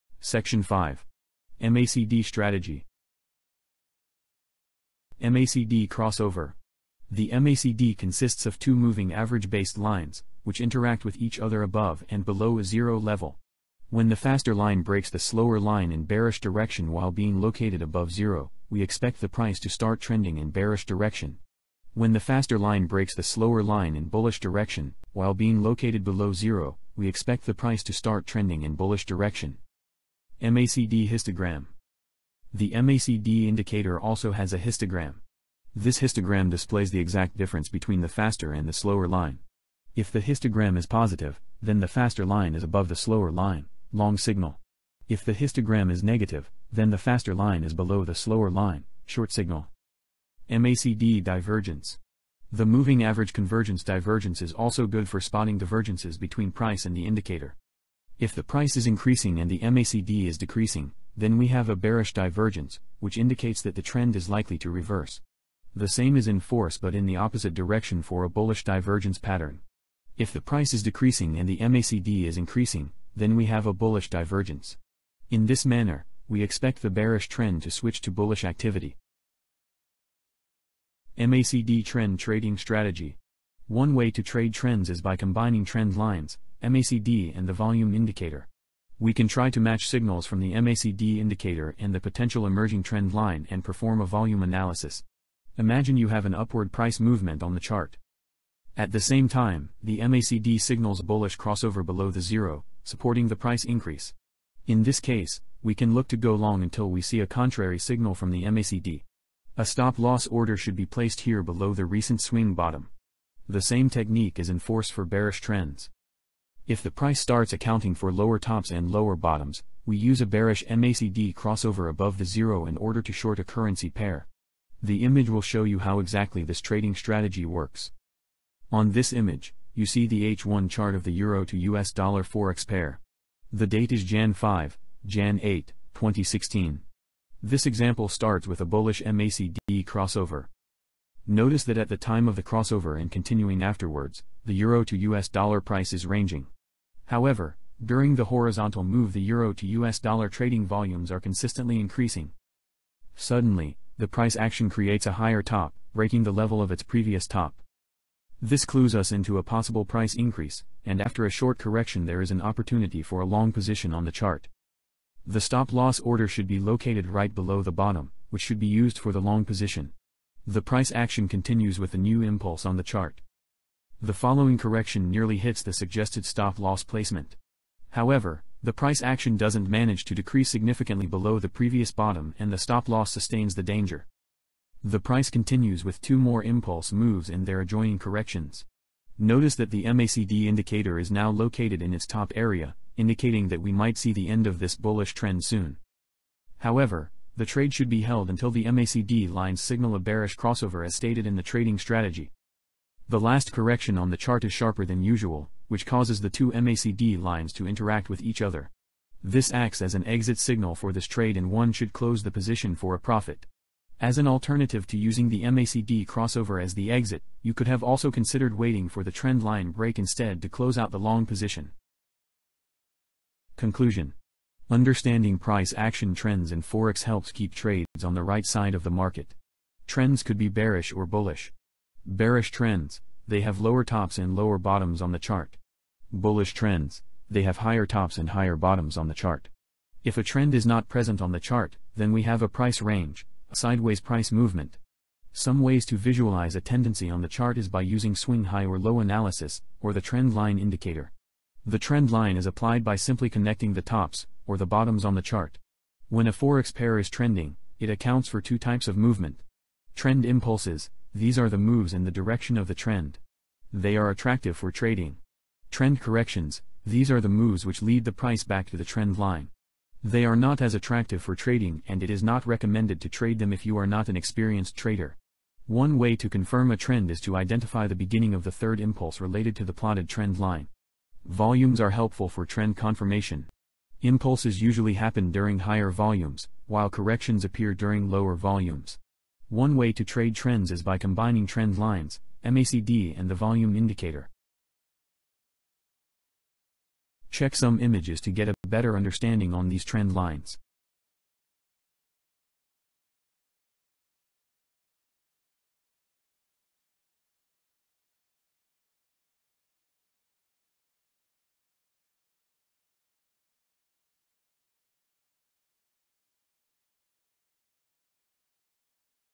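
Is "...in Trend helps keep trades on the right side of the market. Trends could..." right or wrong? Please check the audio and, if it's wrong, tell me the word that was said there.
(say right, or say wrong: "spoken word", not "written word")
wrong: "Forex", not "Trend".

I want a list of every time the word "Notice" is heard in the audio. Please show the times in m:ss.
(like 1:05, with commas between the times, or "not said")
2:21, 3:09.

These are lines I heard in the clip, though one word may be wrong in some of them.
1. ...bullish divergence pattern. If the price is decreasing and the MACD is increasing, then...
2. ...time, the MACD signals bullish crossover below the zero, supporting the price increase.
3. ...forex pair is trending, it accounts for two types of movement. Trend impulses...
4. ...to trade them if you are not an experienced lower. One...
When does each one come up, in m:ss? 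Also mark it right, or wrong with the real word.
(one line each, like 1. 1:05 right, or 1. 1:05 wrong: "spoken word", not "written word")
1. 1:08 right
2. 1:39 right
3. 4:16 right
4. 4:33 wrong: "trader", not "lower".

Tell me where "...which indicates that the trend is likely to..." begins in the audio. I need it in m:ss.
1:02.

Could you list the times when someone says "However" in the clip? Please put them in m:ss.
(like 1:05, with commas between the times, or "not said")
2:27, 2:57, 3:16.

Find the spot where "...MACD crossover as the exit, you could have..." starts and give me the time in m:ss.
3:35.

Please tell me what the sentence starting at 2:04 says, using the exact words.
The image will show you how exactly this trading strategy works.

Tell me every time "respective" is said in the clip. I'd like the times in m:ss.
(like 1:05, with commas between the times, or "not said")
not said.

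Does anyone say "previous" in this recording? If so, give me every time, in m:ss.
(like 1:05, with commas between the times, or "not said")
2:36, 3:01.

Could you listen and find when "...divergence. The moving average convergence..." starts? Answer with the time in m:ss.
0:51.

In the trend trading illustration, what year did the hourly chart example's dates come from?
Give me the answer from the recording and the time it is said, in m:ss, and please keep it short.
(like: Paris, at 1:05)
2016, at 2:15.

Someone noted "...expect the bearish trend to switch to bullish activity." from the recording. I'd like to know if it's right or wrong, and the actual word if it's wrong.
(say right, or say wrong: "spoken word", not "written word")
right.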